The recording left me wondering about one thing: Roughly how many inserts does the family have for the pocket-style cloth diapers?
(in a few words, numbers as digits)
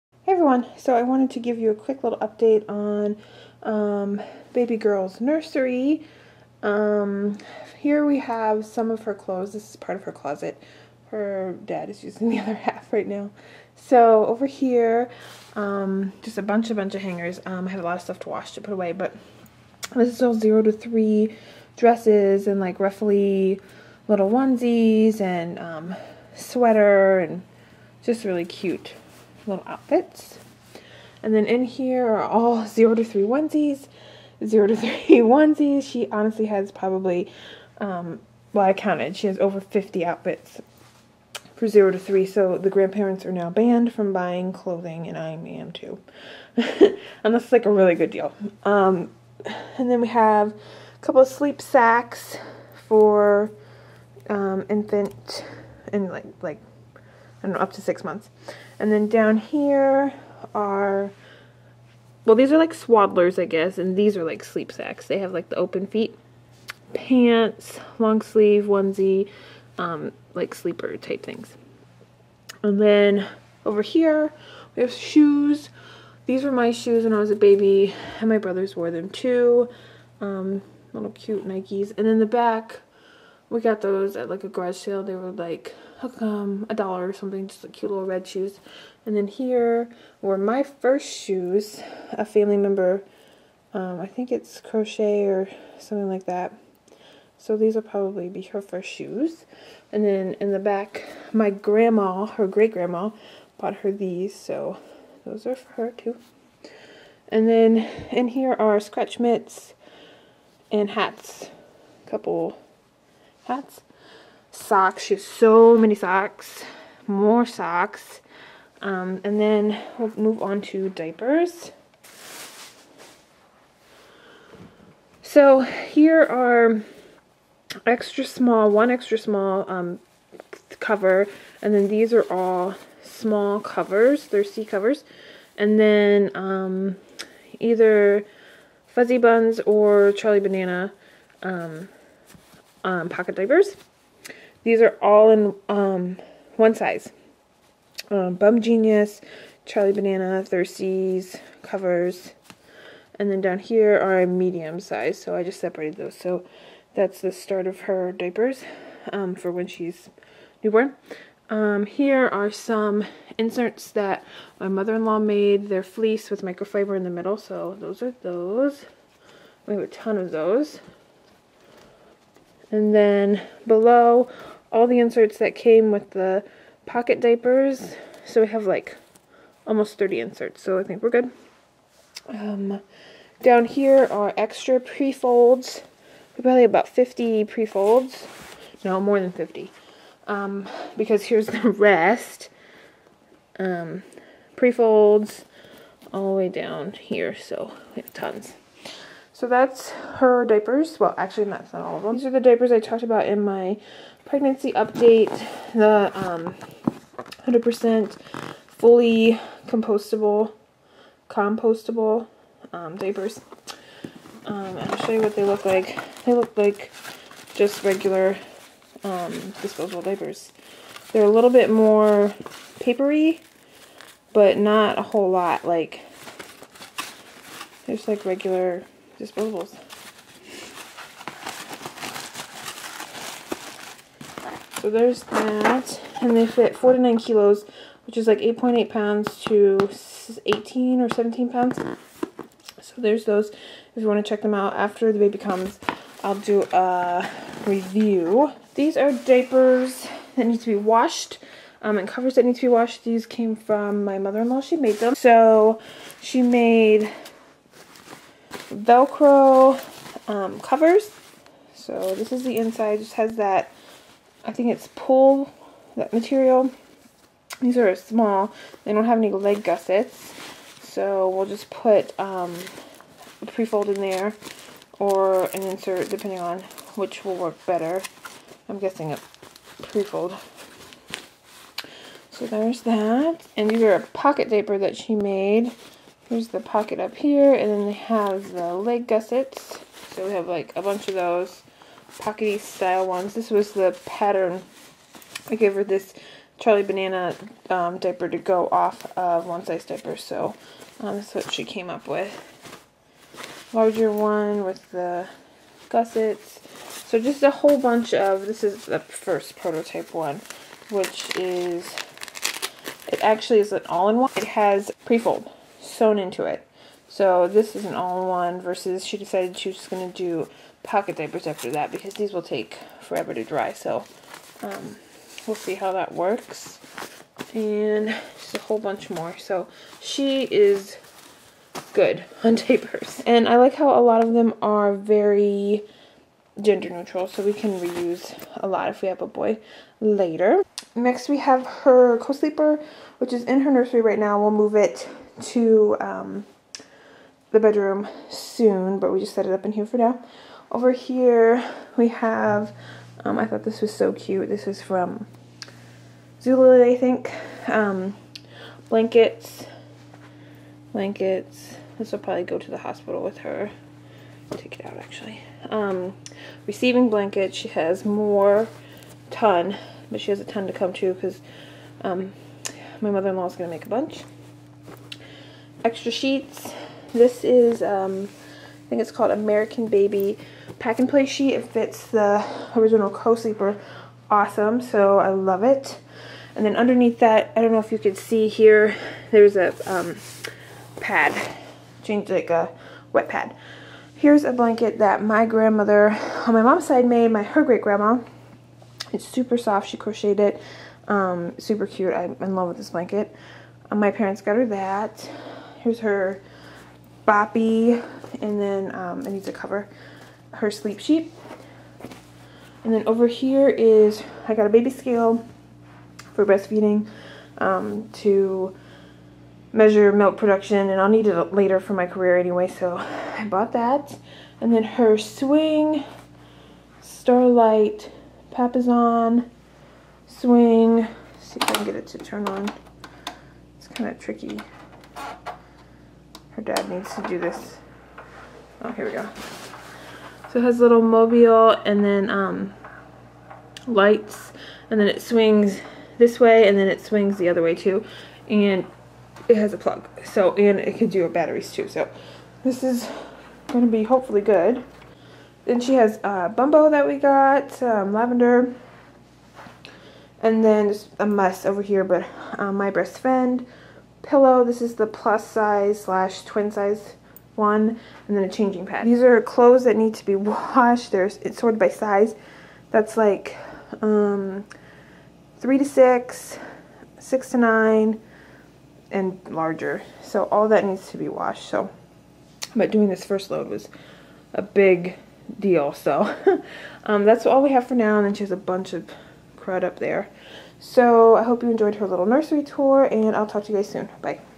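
almost 30.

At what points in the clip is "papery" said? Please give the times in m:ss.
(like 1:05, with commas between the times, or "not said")
3:42.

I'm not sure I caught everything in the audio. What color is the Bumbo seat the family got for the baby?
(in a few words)
Lavender.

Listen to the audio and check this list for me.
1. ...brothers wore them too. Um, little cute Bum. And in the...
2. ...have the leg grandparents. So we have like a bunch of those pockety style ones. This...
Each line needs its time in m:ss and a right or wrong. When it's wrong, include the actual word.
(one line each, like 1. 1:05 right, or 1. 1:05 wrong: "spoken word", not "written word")
1. 1:18 wrong: "Nikes", not "Bum"
2. 4:47 wrong: "gussets", not "grandparents".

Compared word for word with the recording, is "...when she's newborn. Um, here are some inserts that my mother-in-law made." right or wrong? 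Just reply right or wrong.
right.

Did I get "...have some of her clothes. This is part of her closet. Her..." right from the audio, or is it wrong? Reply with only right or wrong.
right.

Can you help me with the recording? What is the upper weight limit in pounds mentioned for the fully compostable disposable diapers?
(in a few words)
18 pounds.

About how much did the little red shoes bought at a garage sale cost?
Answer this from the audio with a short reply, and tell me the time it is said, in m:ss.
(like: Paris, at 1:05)
a dollar, at 1:26.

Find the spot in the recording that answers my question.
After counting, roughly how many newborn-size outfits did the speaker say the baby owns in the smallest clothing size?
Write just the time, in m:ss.
0:39.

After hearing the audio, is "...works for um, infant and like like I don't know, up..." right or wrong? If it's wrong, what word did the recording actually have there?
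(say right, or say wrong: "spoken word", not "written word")
wrong: "sacks", not "works".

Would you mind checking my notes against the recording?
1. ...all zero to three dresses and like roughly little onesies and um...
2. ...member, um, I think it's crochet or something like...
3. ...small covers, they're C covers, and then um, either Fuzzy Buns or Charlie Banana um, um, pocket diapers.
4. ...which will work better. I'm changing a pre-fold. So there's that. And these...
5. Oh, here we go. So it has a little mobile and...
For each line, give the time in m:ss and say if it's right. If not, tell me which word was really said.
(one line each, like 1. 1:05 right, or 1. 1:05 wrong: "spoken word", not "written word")
1. 0:20 right
2. 1:32 right
3. 2:13 right
4. 4:36 wrong: "guessing", not "changing"
5. 7:18 right.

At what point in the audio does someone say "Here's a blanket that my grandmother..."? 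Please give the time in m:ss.
6:34.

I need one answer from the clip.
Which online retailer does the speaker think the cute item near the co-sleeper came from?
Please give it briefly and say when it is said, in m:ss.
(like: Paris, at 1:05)
Zulily, at 5:56.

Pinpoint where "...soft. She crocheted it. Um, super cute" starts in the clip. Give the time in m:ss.
6:39.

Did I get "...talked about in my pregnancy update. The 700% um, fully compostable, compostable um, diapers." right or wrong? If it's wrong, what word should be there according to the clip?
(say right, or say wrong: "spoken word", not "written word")
wrong: "100", not "700".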